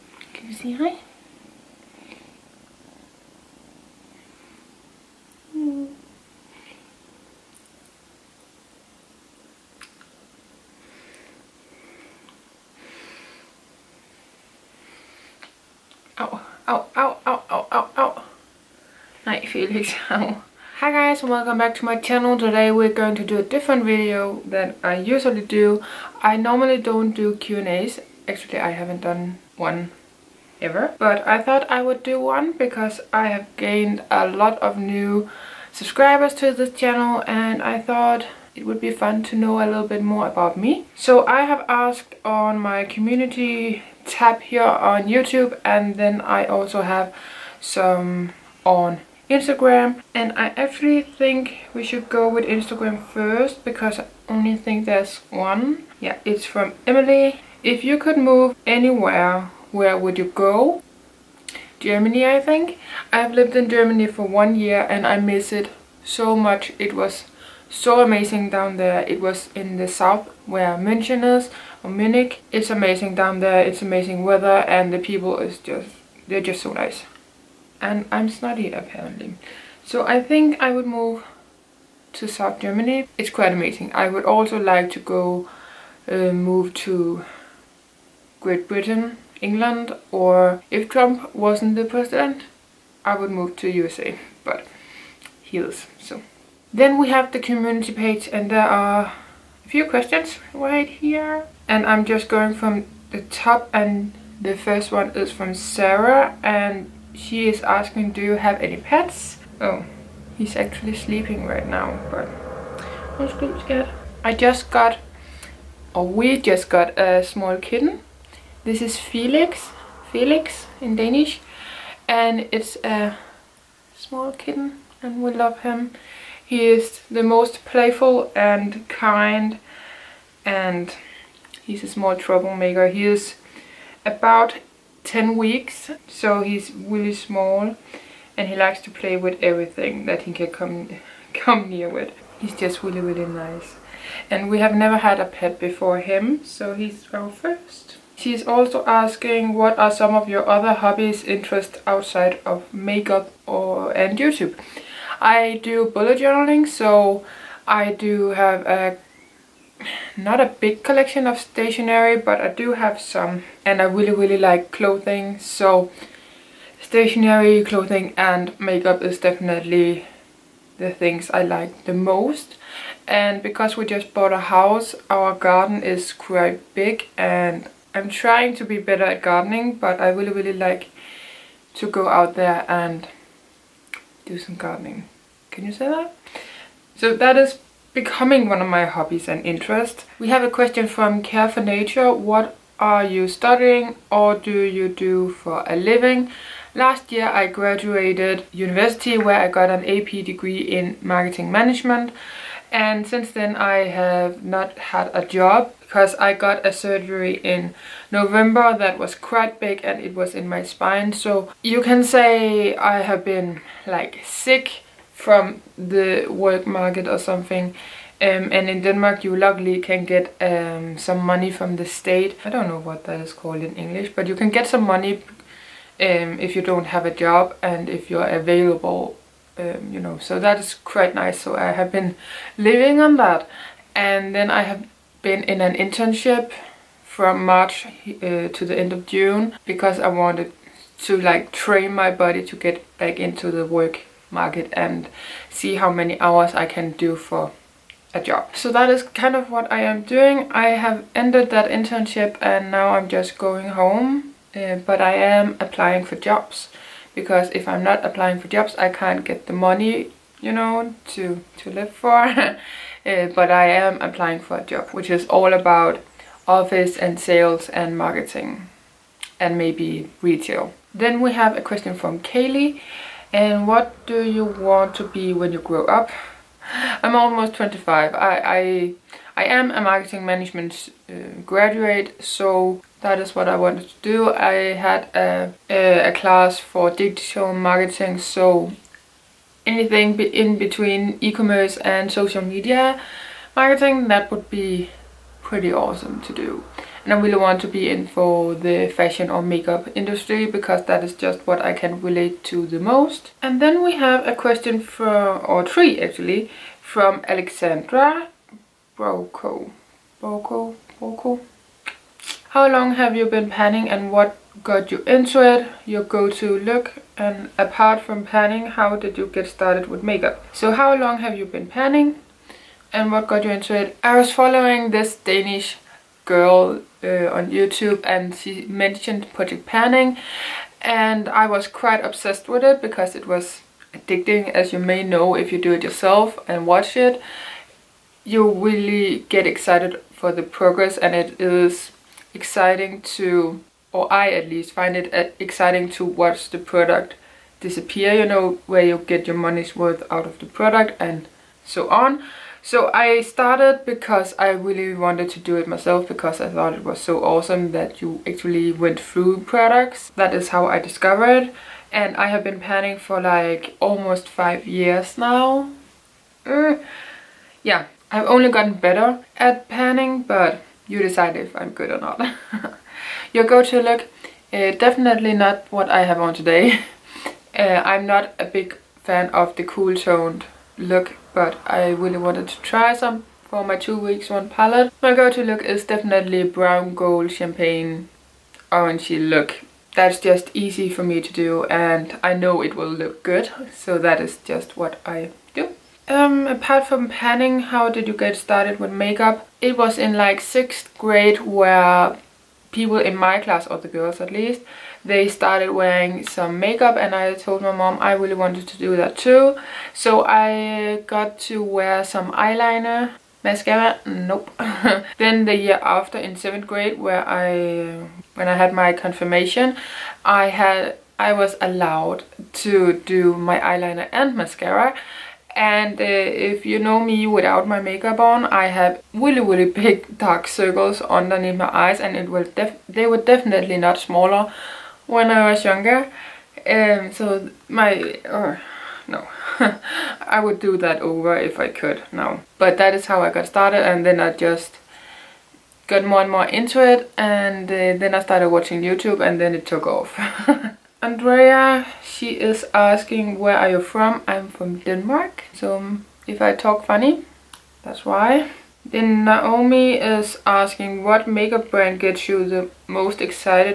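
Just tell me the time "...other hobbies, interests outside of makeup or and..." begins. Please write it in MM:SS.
02:30.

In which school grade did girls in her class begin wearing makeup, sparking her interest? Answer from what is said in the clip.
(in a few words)
6th grade.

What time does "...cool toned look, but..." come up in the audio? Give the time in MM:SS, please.
06:19.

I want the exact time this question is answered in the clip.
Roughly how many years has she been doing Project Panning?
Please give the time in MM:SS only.
06:04.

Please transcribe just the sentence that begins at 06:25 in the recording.
My go-to look is definitely brown gold champagne orangey look.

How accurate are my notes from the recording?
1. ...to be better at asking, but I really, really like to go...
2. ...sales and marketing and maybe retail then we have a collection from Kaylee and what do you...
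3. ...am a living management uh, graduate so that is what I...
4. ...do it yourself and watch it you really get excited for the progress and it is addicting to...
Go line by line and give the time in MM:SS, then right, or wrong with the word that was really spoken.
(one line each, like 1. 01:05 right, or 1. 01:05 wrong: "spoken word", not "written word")
1. 02:58 wrong: "gardening", not "asking"
2. 04:27 wrong: "question", not "collection"
3. 04:39 wrong: "marketing", not "living"
4. 05:35 wrong: "exciting", not "addicting".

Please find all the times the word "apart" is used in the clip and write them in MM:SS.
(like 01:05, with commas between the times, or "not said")
05:17, 06:36.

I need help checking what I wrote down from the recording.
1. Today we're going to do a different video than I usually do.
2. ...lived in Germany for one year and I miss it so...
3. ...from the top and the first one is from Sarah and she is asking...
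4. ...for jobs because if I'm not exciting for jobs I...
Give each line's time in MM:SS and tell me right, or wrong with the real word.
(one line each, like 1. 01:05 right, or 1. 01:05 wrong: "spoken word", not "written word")
1. 00:22 right
2. 01:03 right
3. 01:42 right
4. 04:16 wrong: "applying", not "exciting".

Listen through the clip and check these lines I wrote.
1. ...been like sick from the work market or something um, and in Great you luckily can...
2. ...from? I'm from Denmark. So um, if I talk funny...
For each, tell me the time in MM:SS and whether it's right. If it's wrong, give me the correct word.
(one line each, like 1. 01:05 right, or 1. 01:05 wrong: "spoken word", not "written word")
1. 03:33 wrong: "Denmark", not "Great"
2. 07:33 right.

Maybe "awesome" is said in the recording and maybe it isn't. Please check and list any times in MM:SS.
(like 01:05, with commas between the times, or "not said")
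04:55, 05:57.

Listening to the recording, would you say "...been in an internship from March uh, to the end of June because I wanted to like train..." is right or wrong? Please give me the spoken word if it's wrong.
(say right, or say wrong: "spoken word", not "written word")
right.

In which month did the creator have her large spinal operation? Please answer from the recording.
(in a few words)
November.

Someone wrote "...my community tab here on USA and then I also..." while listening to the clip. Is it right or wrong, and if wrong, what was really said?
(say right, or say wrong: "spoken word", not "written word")
wrong: "YouTube", not "USA".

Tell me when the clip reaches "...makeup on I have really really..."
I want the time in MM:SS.
07:07.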